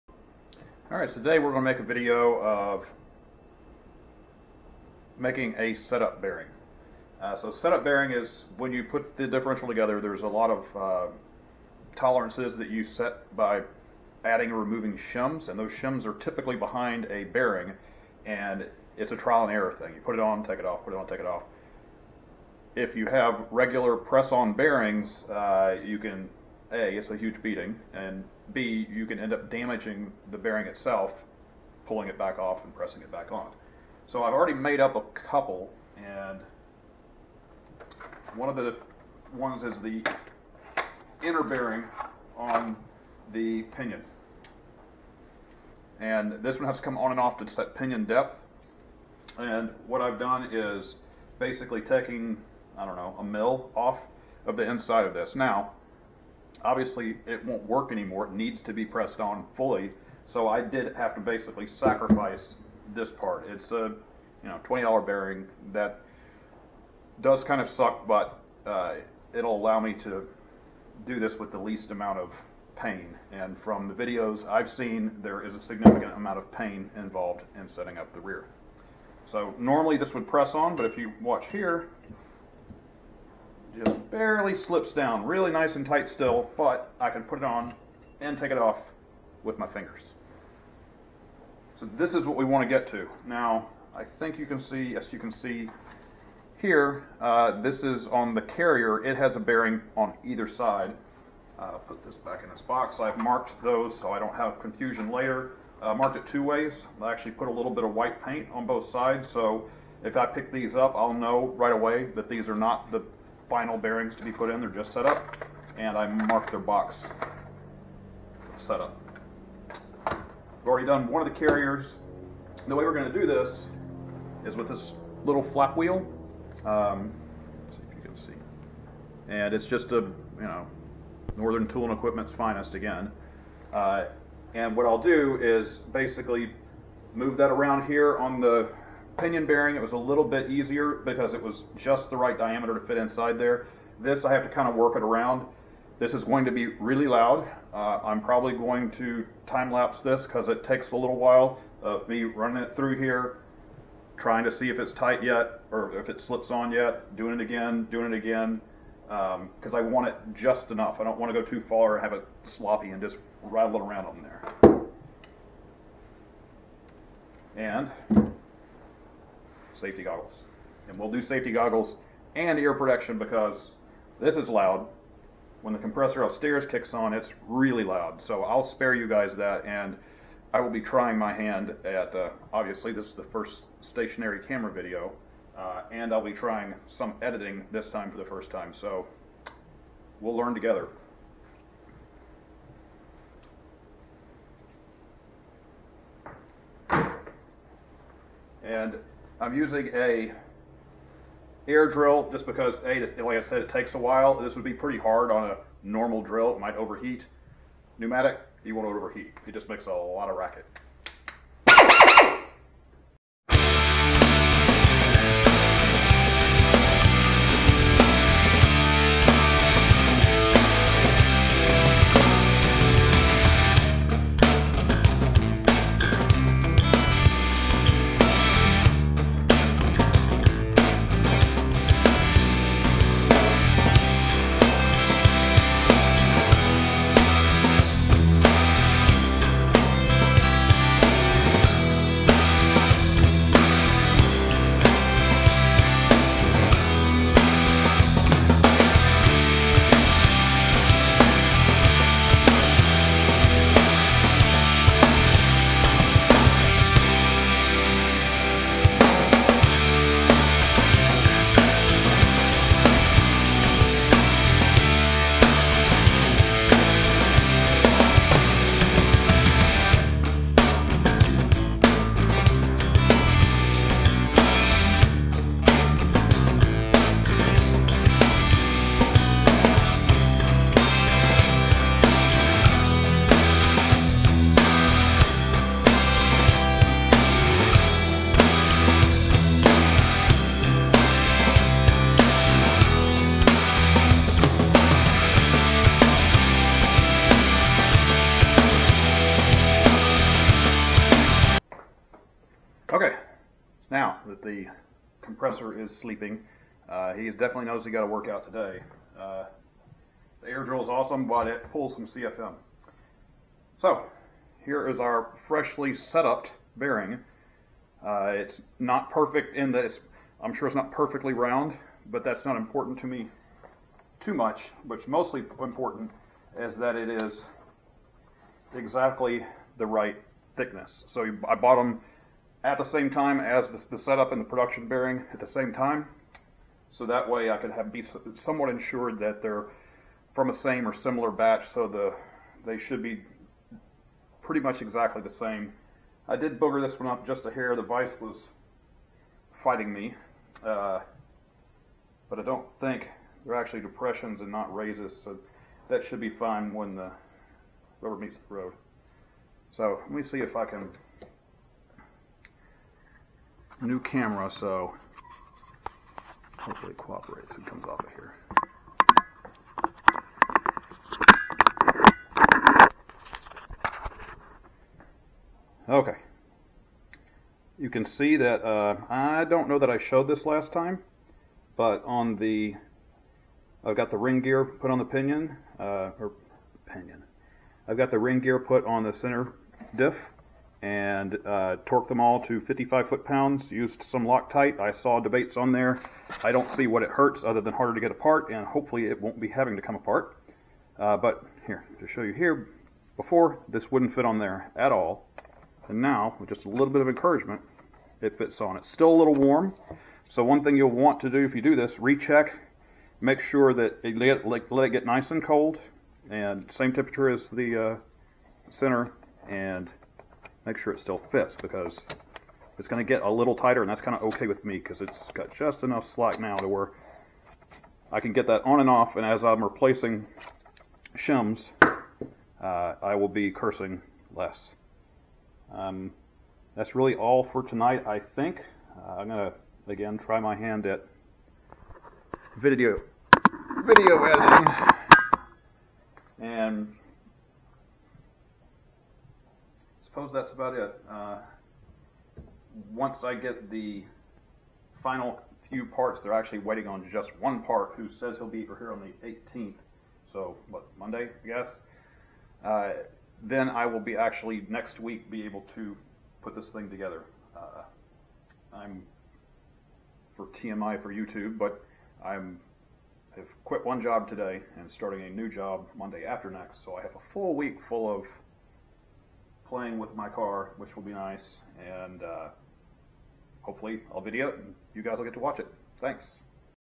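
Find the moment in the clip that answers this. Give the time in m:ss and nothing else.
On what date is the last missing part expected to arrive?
7:39.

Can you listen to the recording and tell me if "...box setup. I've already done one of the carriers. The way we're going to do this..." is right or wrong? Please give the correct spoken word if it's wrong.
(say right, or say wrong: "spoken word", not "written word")
right.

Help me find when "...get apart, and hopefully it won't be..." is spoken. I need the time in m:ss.
6:37.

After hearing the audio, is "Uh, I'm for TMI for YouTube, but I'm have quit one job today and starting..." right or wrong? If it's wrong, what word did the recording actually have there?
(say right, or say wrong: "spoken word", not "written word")
right.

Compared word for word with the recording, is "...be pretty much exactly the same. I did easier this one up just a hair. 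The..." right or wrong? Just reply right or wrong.
wrong.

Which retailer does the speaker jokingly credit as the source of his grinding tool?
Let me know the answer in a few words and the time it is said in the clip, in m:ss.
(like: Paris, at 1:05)
Northern Tool and Equipment, at 2:11.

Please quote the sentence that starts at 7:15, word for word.
Um, that's really all for tonight I think.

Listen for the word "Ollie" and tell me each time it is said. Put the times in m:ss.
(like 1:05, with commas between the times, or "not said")
not said.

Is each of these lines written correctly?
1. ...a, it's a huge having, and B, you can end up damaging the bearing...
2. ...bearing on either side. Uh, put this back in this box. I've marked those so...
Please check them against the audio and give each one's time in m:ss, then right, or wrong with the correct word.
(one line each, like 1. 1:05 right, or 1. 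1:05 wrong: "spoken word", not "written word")
1. 0:26 wrong: "beating", not "having"
2. 1:39 right.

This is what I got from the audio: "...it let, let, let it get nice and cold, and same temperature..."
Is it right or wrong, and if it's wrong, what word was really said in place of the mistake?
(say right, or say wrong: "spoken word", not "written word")
right.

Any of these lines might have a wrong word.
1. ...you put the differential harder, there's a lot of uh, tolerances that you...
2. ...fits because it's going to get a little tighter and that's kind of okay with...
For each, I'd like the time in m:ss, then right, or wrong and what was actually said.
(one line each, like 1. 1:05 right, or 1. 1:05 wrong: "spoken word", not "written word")
1. 0:08 wrong: "together", not "harder"
2. 7:01 right.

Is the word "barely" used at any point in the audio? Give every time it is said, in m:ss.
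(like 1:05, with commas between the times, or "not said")
1:24.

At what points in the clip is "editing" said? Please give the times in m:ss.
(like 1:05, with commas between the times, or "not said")
3:07, 7:24.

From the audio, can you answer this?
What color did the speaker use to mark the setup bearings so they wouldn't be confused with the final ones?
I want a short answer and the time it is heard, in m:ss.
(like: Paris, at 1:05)
White, at 1:47.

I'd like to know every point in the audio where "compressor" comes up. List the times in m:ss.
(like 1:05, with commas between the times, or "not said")
2:55, 5:05.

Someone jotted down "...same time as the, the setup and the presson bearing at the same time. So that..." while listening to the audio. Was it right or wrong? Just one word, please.
wrong.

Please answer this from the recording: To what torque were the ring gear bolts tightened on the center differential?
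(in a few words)
55 foot pounds.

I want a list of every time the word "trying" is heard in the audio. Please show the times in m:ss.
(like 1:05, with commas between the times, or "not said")
2:34, 3:00, 3:06.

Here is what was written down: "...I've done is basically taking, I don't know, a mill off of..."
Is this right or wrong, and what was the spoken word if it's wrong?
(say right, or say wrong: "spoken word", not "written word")
right.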